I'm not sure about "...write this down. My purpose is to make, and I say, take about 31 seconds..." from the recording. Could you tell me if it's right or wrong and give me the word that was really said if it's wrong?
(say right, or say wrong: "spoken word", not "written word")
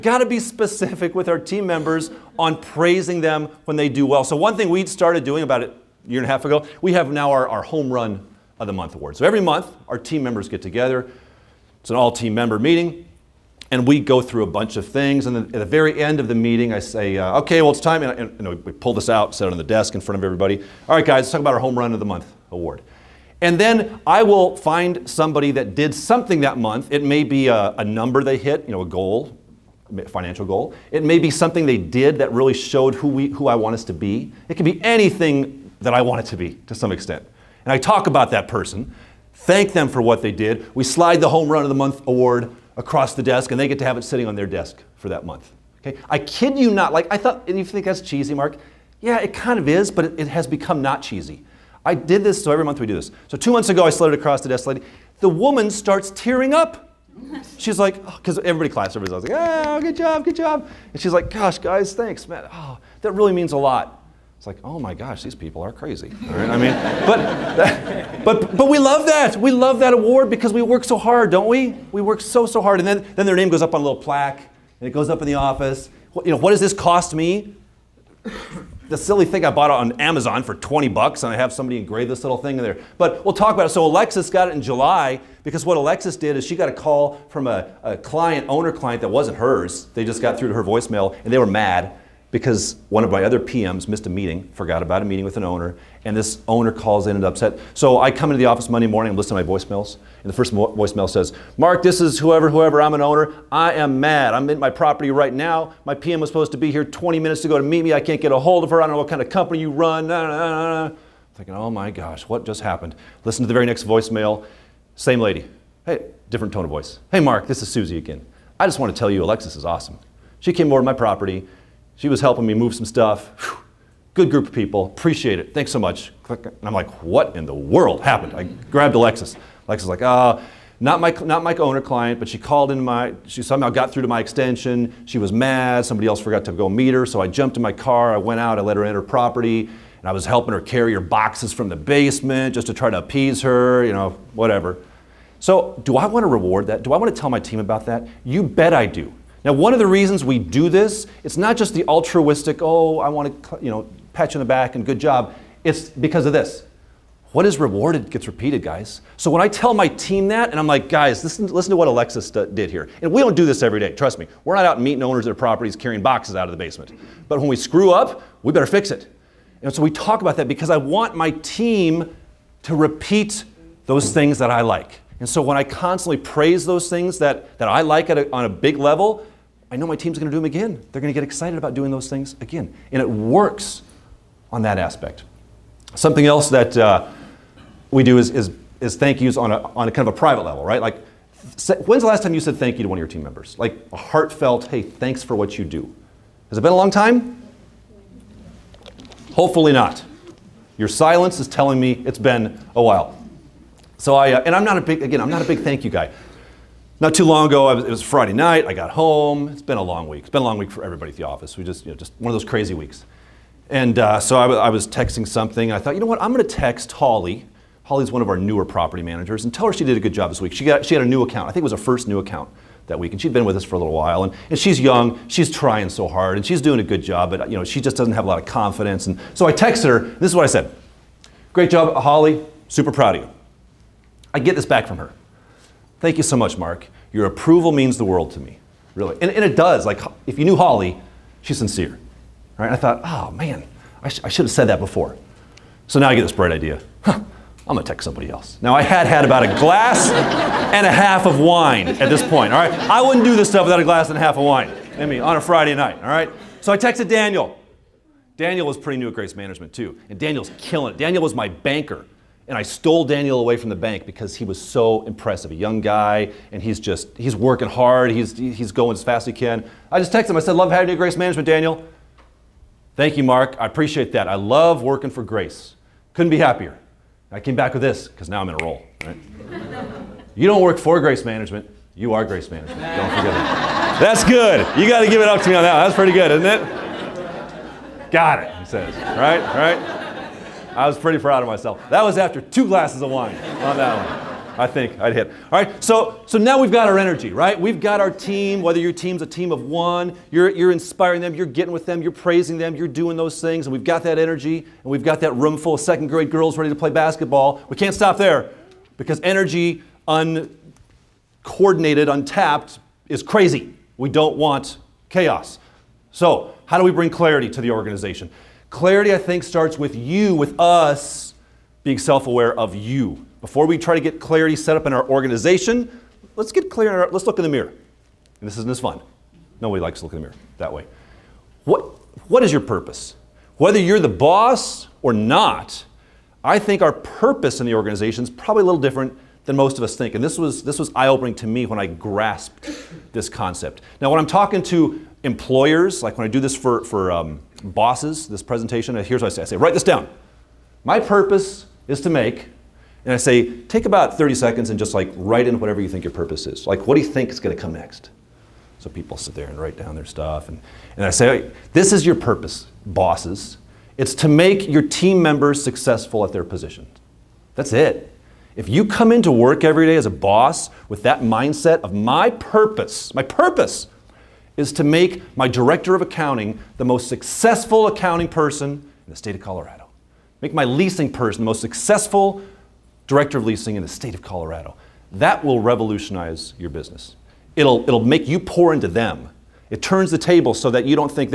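wrong: "30", not "31".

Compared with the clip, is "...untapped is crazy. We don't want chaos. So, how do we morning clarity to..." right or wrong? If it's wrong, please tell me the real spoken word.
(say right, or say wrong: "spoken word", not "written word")
wrong: "bring", not "morning".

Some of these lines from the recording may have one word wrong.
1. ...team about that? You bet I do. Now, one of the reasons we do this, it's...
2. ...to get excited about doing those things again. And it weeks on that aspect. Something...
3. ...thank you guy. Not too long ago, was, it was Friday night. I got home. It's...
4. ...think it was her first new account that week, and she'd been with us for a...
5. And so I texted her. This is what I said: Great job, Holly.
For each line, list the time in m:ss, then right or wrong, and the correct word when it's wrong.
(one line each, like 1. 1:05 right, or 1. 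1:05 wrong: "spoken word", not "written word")
1. 2:27 right
2. 3:01 wrong: "works", not "weeks"
3. 3:25 right
4. 3:41 right
5. 3:49 right.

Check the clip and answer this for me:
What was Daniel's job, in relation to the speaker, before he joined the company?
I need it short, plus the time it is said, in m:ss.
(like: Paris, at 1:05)
Banker, at 4:21.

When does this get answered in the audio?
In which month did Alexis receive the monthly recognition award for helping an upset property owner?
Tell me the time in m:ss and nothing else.
1:24.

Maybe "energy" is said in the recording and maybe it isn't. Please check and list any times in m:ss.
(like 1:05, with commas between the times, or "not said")
4:56, 5:04, 5:09.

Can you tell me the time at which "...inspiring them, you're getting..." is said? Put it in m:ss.
5:00.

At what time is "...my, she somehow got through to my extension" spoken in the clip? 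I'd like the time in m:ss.
2:12.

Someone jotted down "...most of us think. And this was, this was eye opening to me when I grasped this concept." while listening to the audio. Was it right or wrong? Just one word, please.
right.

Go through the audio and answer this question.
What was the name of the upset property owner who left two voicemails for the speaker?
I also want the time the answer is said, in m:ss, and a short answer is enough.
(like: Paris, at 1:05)
Susie, at 1:57.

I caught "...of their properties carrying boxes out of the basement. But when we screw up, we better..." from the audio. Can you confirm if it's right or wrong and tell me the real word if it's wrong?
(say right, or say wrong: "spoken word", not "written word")
right.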